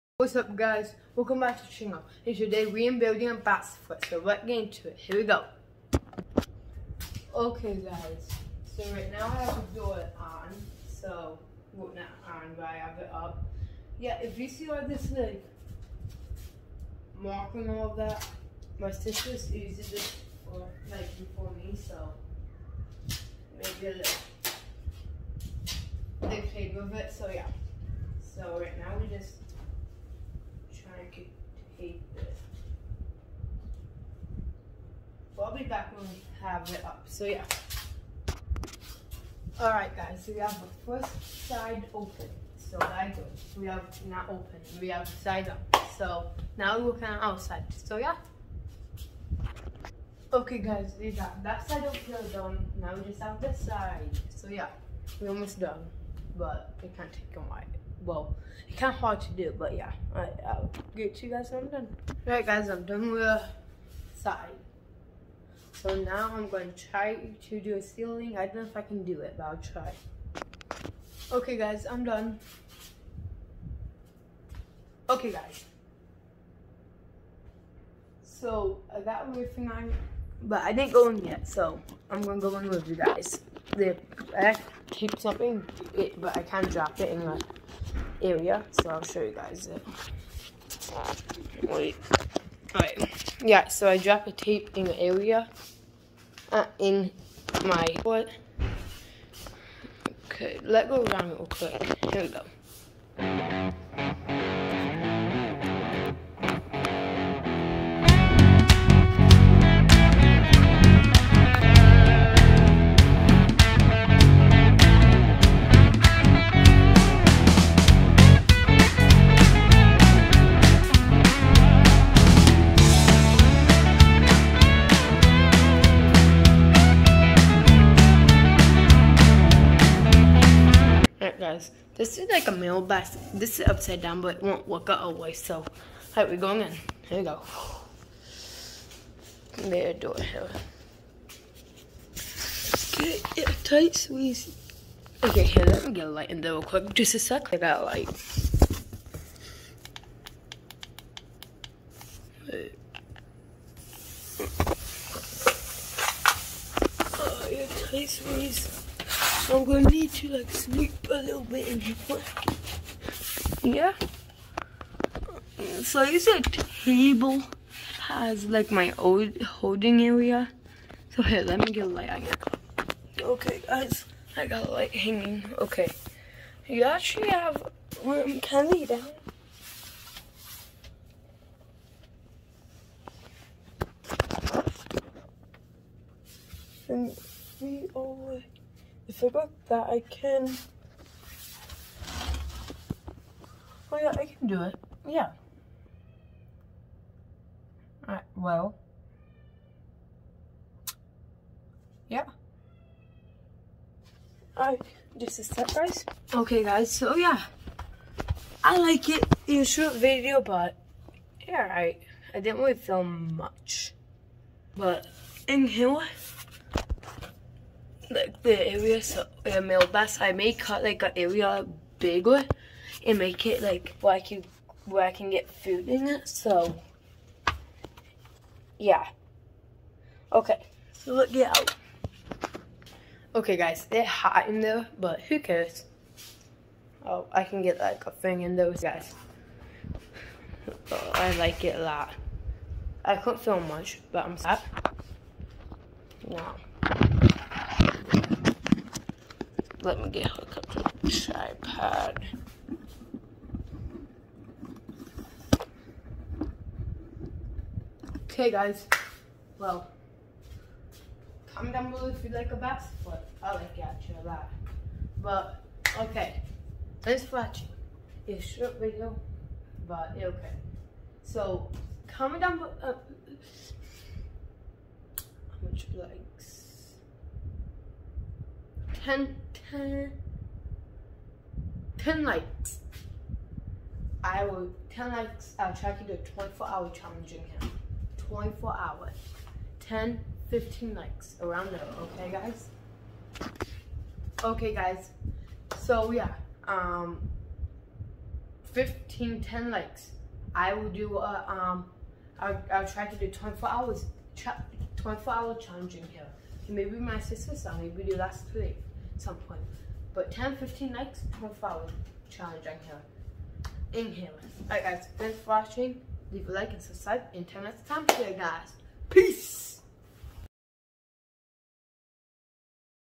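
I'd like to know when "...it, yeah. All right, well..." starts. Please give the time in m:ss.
3:14.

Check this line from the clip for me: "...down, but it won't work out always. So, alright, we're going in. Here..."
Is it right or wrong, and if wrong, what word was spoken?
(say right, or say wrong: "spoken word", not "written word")
right.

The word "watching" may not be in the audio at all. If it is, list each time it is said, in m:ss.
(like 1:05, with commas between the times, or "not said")
4:27, 5:15.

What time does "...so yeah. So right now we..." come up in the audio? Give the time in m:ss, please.
0:27.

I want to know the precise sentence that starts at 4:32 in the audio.
Uh, how much like 10, likes, I will, 10 likes, I'll try to do a 24 hour challenging.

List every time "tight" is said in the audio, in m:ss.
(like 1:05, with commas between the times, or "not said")
2:23, 2:37.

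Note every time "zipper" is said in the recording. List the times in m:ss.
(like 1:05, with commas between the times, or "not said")
3:09.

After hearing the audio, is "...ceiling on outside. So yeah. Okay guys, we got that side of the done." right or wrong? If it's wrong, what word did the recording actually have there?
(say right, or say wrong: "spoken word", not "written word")
wrong: "working", not "ceiling".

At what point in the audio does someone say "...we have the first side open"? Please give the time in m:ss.
0:40.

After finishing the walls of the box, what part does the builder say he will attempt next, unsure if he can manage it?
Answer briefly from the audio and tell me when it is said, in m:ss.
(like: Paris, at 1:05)
Ceiling, at 1:07.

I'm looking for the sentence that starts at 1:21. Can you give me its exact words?
So I'm gonna go in with you guys.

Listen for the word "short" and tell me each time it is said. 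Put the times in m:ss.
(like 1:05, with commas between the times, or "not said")
3:29, 4:28.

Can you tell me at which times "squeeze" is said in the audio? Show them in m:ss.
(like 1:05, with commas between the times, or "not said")
2:23, 2:38.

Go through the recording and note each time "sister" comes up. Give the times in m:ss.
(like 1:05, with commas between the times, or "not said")
0:18, 5:07.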